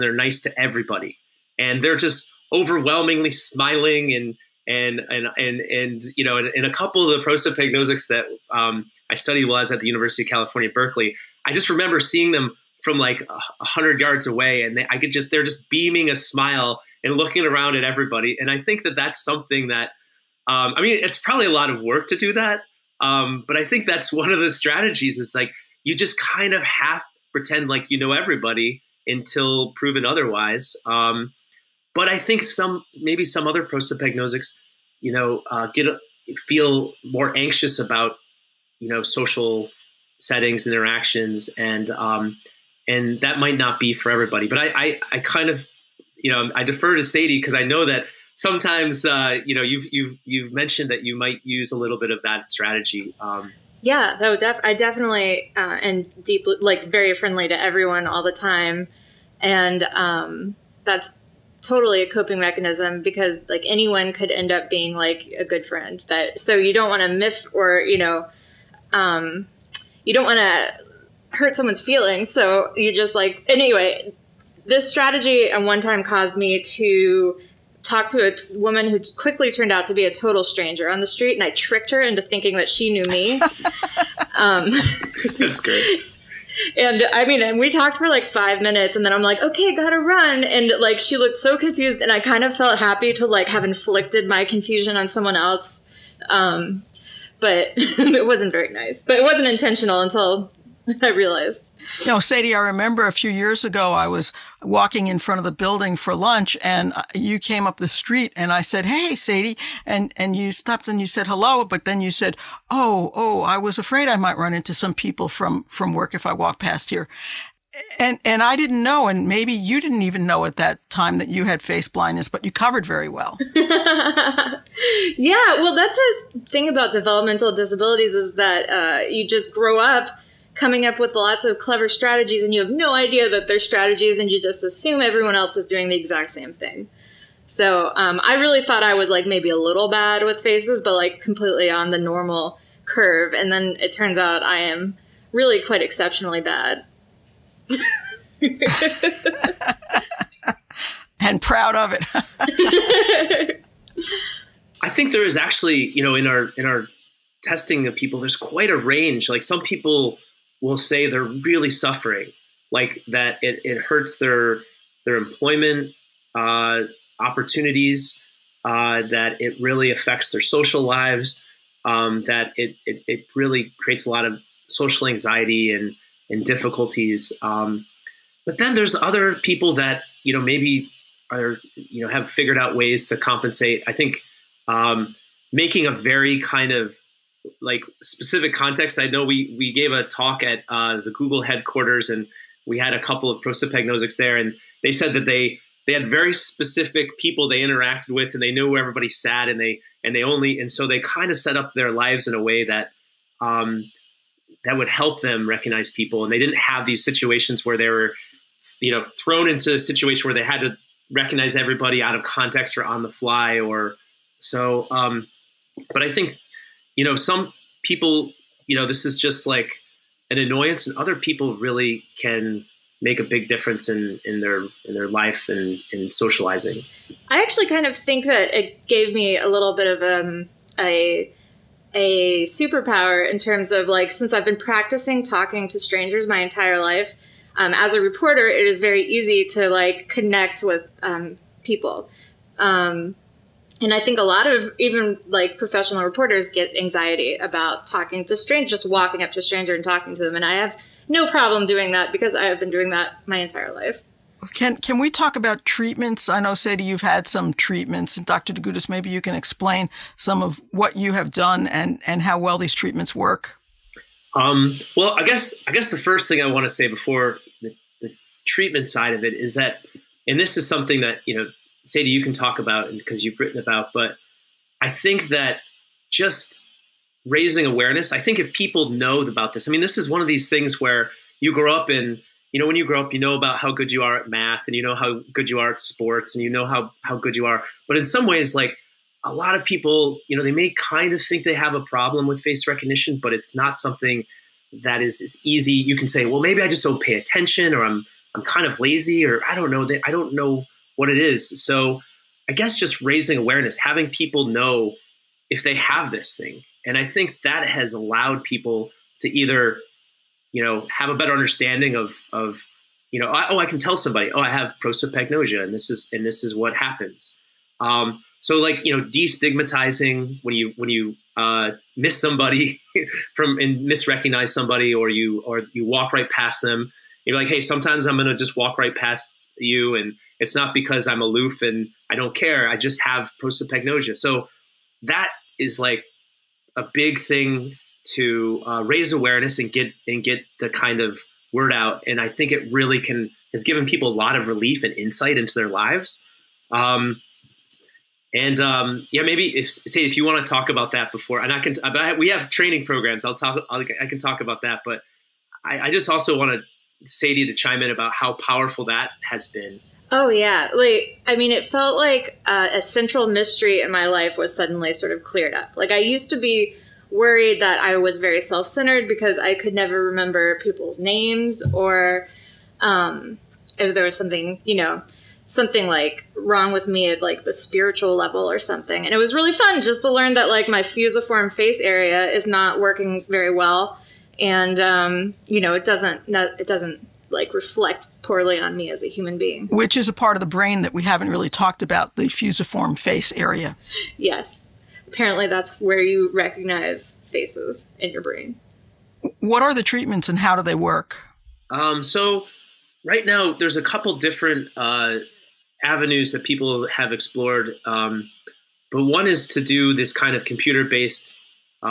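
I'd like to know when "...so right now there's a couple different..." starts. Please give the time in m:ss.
6:42.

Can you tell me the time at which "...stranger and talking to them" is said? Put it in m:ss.
4:09.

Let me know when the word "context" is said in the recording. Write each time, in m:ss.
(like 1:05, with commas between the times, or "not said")
3:08, 3:32.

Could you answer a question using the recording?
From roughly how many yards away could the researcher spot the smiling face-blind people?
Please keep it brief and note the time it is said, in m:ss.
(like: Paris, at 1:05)
100, at 0:13.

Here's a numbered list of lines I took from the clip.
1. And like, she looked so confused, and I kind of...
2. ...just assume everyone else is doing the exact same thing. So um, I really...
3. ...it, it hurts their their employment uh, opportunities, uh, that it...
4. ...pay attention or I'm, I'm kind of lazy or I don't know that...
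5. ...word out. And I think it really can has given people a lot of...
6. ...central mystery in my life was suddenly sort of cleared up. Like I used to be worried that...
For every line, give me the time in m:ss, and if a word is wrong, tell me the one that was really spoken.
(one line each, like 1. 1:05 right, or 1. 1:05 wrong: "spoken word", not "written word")
1. 1:30 right
2. 2:14 right
3. 2:43 right
4. 4:57 right
5. 5:41 right
6. 6:02 right.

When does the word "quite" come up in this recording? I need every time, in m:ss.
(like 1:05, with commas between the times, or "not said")
2:25, 2:38.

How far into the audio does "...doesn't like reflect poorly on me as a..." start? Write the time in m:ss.
6:26.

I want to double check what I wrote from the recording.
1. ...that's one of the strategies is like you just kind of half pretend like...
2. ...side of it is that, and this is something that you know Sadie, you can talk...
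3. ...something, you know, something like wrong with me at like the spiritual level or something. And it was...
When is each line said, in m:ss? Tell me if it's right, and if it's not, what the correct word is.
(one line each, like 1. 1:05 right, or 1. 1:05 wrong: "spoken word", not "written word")
1. 0:23 right
2. 4:28 right
3. 6:14 right.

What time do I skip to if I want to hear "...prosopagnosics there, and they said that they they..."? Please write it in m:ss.
3:13.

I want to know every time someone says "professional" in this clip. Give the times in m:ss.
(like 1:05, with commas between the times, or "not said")
4:05.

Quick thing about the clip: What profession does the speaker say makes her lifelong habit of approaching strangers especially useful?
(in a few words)
Reporter.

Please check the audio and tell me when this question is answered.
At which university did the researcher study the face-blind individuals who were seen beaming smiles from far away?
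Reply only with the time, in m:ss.
0:09.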